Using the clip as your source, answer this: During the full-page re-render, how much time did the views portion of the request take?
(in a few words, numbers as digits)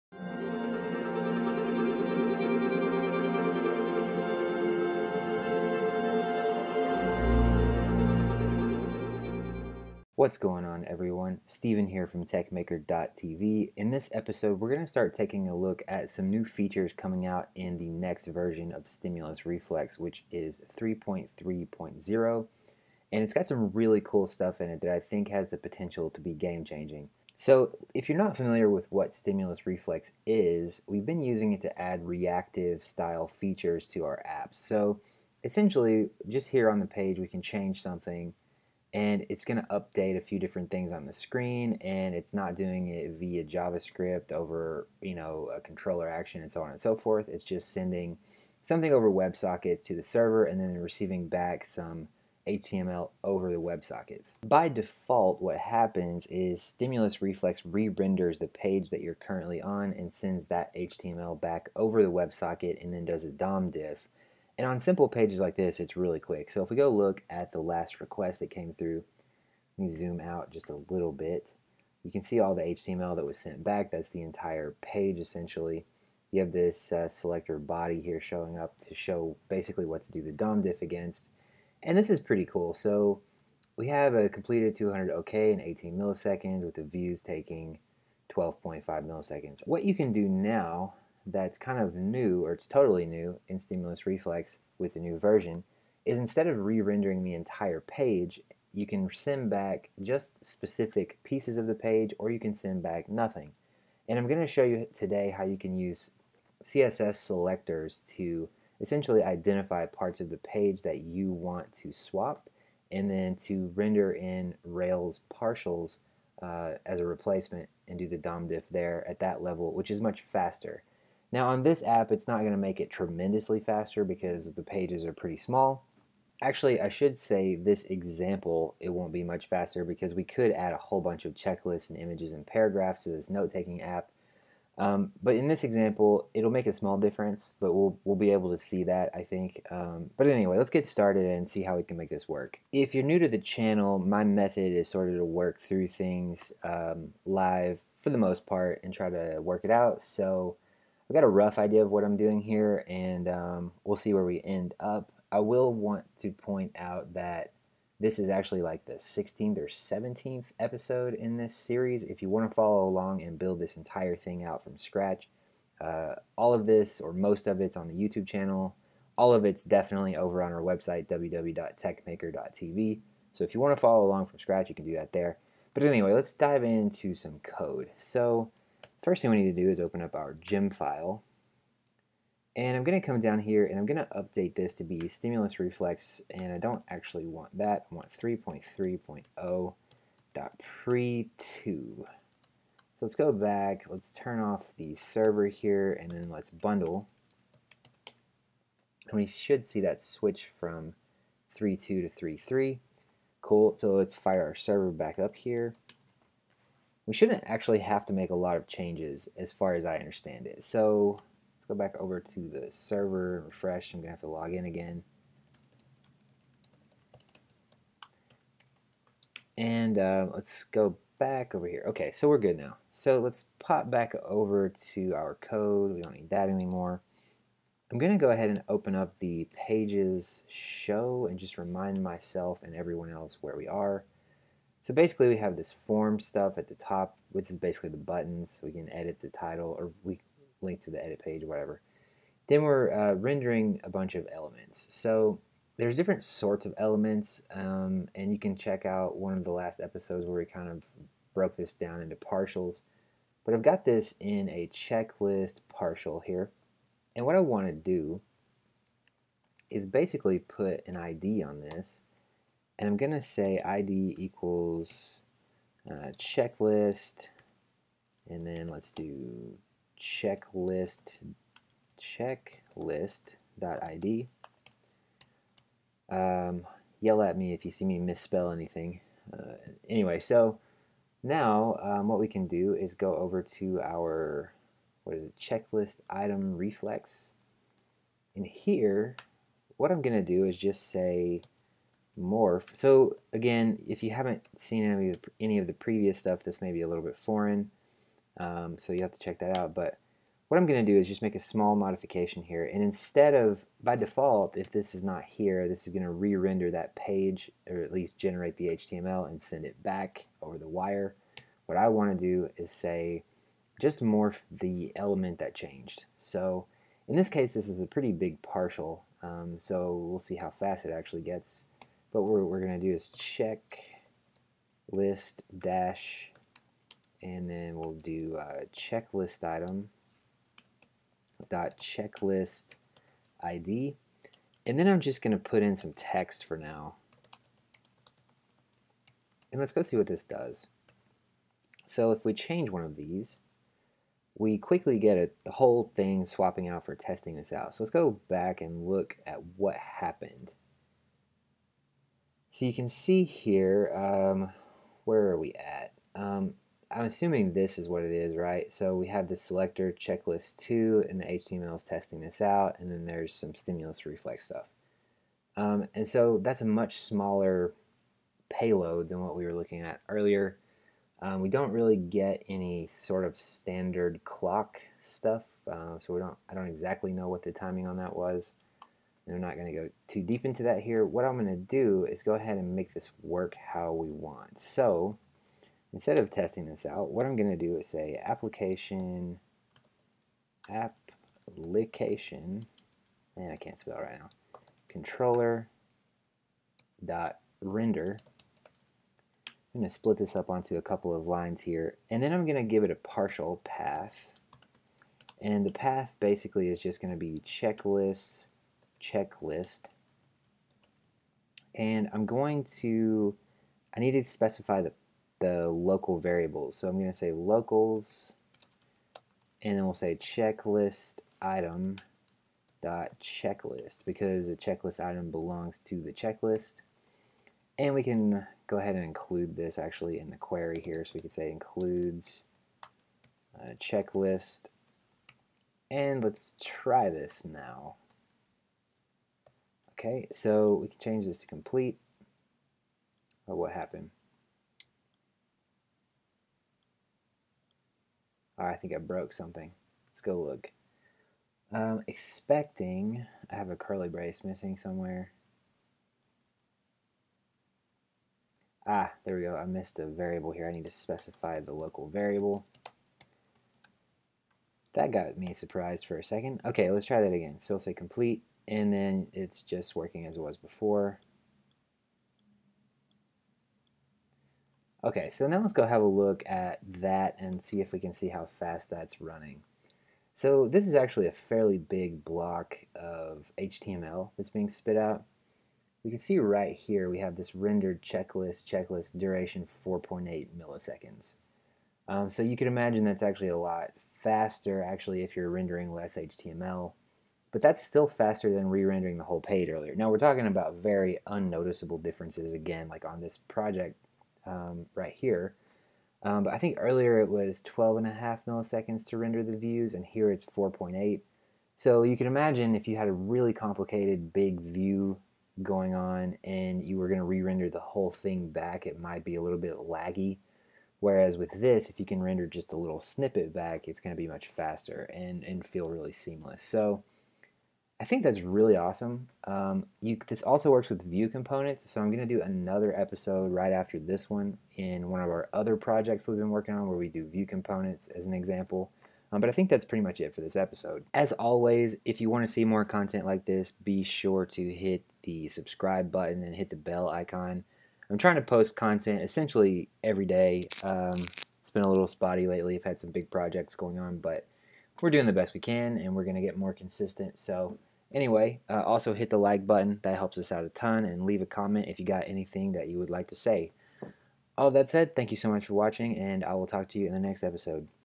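12.5 milliseconds.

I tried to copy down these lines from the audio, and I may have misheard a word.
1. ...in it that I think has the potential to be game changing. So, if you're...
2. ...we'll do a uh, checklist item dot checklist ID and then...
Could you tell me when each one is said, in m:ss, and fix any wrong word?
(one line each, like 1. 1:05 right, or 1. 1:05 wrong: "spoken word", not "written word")
1. 0:24 right
2. 5:27 right.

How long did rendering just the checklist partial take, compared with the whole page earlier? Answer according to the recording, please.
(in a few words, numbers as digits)
4.8 milliseconds.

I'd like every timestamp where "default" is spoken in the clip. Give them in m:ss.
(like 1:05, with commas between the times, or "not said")
0:54, 5:03.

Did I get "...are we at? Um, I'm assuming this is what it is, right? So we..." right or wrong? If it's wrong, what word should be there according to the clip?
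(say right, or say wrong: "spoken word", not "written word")
right.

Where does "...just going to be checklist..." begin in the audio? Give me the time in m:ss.
6:46.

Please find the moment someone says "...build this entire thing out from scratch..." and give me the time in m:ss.
2:43.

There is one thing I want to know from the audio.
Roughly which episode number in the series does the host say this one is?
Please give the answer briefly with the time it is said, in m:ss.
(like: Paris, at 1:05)
16th or 17th, at 2:38.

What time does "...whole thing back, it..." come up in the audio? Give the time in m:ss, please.
8:37.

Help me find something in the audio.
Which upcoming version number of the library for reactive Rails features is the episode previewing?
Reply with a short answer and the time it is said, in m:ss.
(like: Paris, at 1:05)
3.3.0, at 0:20.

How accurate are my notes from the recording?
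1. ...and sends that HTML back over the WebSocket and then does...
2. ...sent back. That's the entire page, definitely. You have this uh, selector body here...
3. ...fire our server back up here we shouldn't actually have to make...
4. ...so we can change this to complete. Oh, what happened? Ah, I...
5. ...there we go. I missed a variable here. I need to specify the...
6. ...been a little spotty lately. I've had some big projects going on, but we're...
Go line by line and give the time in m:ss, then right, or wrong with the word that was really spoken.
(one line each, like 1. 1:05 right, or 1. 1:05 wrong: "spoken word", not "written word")
1. 0:59 right
2. 1:13 wrong: "essentially", not "definitely"
3. 3:24 right
4. 7:20 right
5. 7:39 right
6. 9:11 right.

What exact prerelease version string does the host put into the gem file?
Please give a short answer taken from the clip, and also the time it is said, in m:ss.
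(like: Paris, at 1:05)
3.3.0.pre2, at 3:08.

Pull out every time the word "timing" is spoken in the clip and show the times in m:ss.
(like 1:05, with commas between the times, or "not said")
6:17.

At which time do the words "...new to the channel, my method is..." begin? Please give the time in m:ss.
2:23.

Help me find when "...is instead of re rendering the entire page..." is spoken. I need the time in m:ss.
1:36.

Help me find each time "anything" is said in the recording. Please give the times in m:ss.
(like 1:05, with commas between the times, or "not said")
4:38, 9:22.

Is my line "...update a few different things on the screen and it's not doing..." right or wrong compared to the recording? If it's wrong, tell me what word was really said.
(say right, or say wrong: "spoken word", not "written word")
right.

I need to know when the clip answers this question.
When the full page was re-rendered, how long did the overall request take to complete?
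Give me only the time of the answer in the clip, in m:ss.
1:25.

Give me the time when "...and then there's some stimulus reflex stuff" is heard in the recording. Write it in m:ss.
6:02.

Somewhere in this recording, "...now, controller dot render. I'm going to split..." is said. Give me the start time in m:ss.
6:34.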